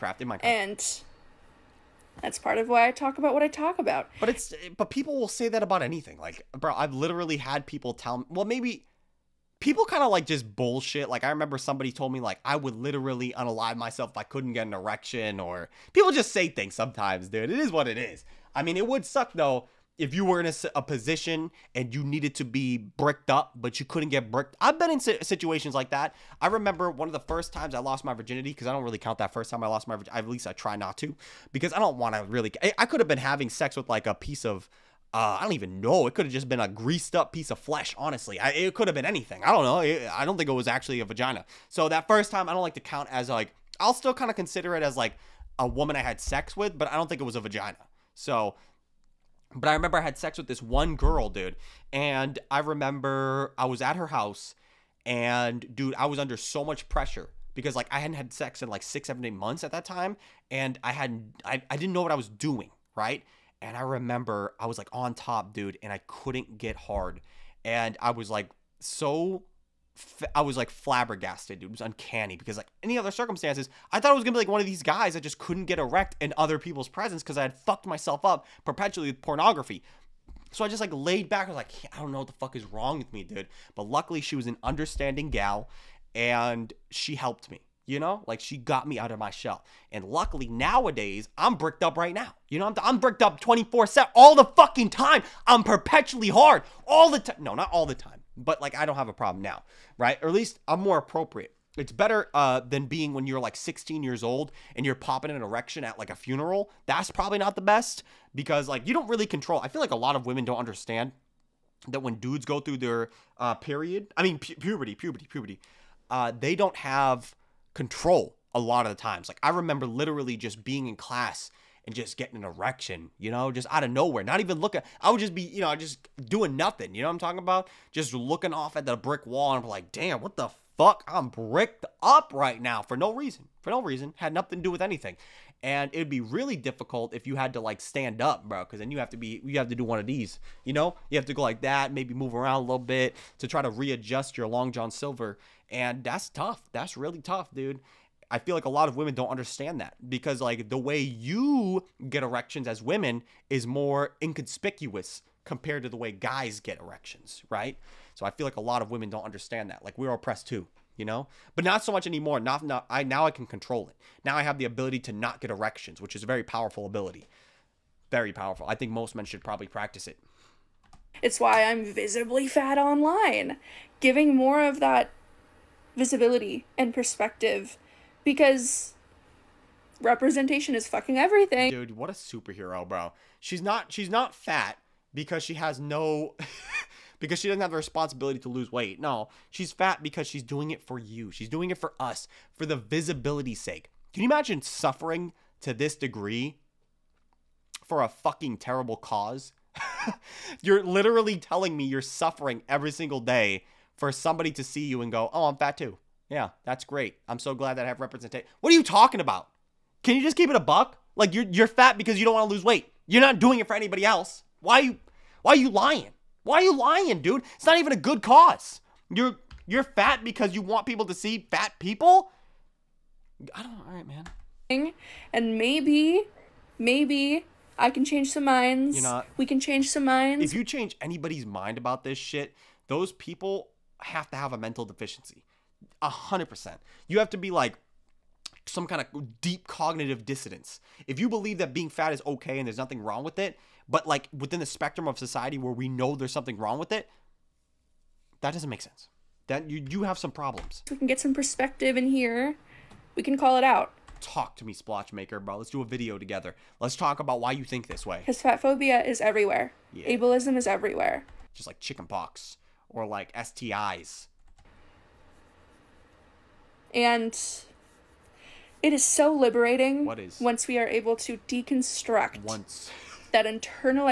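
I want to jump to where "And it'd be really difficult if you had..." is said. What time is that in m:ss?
2:15.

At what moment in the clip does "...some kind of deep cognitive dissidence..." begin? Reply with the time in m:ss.
3:58.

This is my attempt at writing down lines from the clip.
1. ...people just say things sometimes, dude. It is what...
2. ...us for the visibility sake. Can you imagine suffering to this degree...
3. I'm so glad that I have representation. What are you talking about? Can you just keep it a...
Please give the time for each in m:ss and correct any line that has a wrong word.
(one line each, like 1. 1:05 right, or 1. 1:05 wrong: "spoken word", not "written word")
1. 0:15 right
2. 3:11 right
3. 3:27 right.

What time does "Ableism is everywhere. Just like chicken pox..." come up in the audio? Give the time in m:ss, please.
4:20.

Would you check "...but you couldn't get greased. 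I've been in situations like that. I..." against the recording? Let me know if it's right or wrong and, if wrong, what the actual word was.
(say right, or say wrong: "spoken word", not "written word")
wrong: "bricked", not "greased".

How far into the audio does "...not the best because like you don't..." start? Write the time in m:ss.
1:47.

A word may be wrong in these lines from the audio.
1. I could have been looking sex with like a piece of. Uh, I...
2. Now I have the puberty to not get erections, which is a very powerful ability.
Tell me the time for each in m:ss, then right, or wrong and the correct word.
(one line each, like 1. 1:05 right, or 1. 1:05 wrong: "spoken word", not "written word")
1. 0:32 wrong: "having", not "looking"
2. 2:44 wrong: "ability", not "puberty".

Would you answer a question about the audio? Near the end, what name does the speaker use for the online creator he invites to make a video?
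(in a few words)
Splotch Maker.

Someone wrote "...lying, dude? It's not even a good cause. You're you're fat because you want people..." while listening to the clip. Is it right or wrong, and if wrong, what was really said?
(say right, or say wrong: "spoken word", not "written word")
right.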